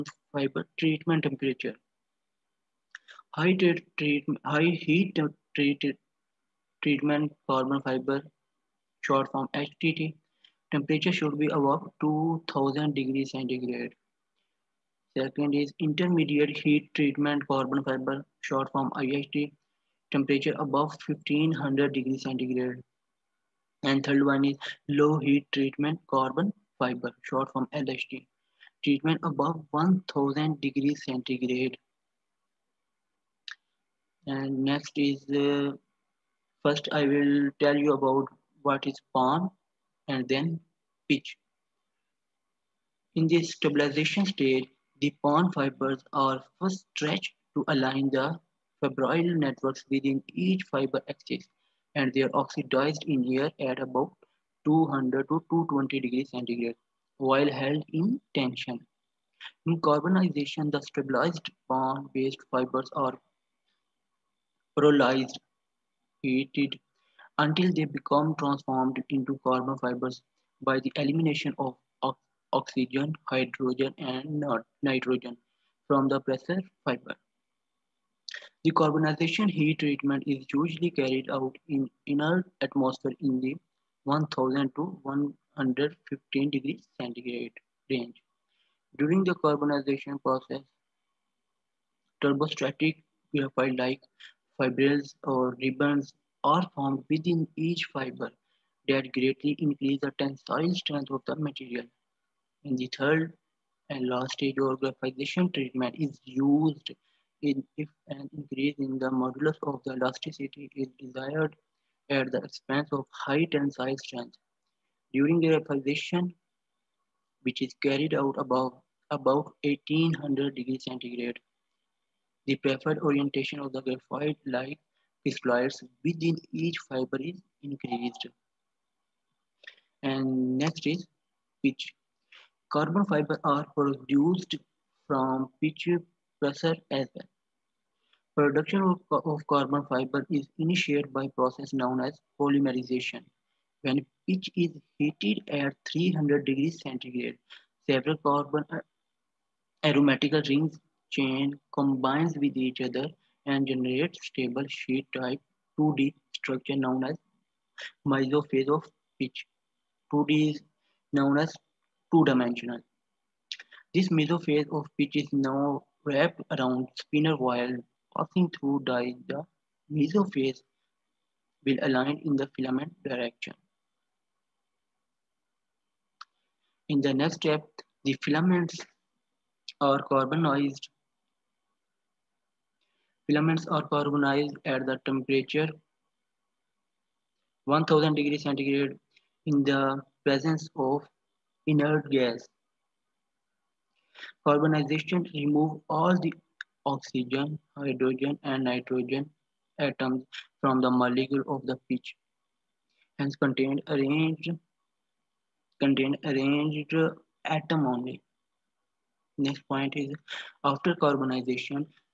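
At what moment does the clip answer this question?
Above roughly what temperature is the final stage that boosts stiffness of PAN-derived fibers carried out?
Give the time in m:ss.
1:59.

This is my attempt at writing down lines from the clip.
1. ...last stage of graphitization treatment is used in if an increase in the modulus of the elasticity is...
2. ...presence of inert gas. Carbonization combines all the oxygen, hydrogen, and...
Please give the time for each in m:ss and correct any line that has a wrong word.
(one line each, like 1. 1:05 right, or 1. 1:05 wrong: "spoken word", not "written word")
1. 1:44 right
2. 3:10 wrong: "removes", not "combines".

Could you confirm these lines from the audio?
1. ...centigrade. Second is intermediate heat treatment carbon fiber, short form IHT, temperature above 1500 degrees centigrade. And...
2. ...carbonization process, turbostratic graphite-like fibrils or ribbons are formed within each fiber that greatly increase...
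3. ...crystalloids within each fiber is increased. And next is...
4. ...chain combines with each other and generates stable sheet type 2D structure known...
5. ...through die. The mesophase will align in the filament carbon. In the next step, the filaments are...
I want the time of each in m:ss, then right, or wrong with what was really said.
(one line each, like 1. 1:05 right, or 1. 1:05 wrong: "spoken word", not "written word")
1. 0:13 right
2. 1:29 right
3. 2:05 right
4. 2:31 right
5. 2:48 wrong: "direction", not "carbon".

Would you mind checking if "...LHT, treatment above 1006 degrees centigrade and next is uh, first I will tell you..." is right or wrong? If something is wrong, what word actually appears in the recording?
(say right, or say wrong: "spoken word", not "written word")
wrong: "1000", not "1006".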